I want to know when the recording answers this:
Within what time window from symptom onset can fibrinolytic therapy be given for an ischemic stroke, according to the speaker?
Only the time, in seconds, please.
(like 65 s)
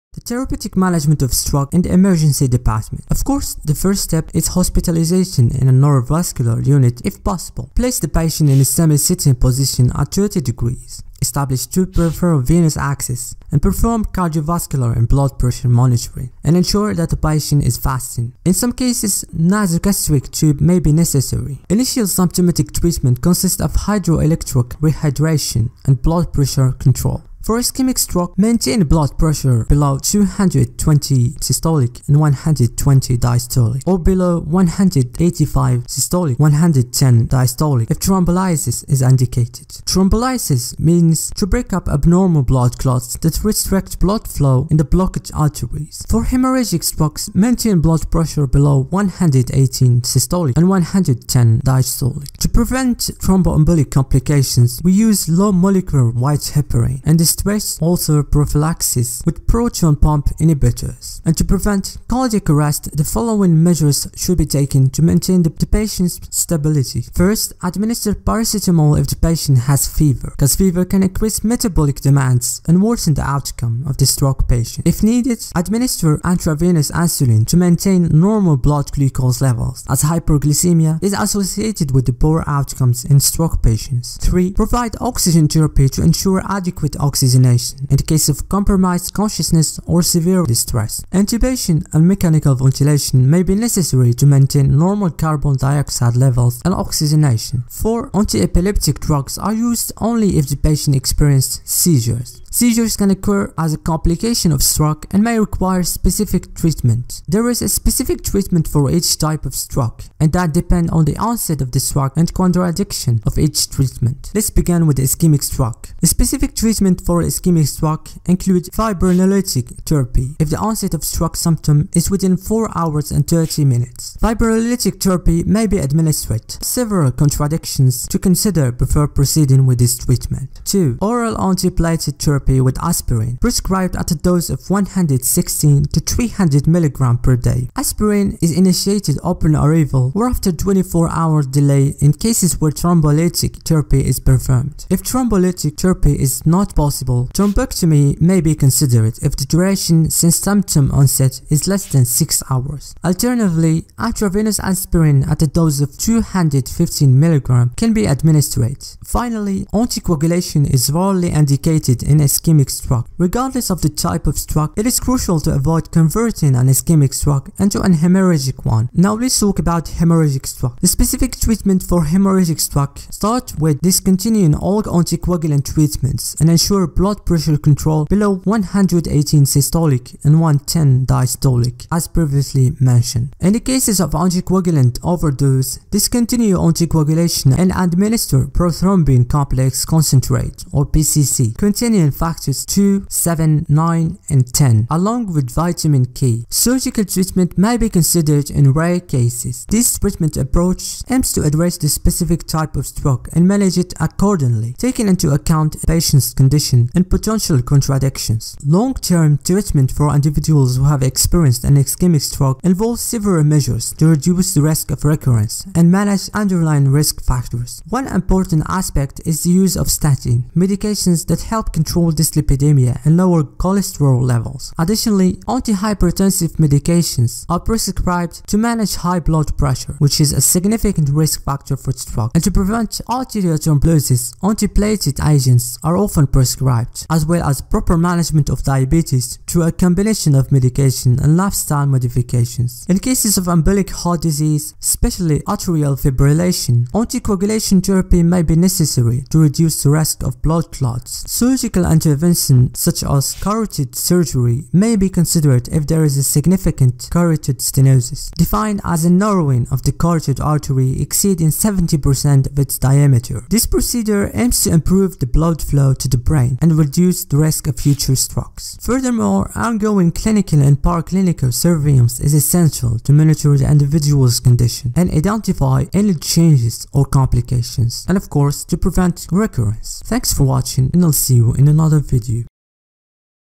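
122 s.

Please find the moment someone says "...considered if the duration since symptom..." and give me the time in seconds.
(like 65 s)
148 s.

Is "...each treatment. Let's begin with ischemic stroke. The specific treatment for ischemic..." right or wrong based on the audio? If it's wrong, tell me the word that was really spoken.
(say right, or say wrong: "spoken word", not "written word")
right.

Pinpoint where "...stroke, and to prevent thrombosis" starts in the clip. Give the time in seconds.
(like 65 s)
231 s.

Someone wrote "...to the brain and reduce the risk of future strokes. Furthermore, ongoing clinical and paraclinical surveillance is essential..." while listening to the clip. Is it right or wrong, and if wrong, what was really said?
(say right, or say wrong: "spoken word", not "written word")
right.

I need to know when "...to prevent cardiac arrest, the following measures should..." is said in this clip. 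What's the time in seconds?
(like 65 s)
61 s.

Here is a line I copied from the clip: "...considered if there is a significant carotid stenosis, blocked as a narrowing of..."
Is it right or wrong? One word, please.
wrong.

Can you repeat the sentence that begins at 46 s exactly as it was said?
For hemorrhagic strokes, maintain blood pressure below 118 systolic and 110 diastolic.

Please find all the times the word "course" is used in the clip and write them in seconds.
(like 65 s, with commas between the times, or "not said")
3 s, 278 s.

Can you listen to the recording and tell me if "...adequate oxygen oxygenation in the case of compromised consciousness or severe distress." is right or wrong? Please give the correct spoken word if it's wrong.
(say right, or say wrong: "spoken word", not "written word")
right.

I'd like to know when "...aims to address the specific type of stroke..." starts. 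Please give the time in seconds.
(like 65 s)
201 s.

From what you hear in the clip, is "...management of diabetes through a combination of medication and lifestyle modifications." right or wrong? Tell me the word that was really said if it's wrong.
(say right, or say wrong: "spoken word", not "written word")
right.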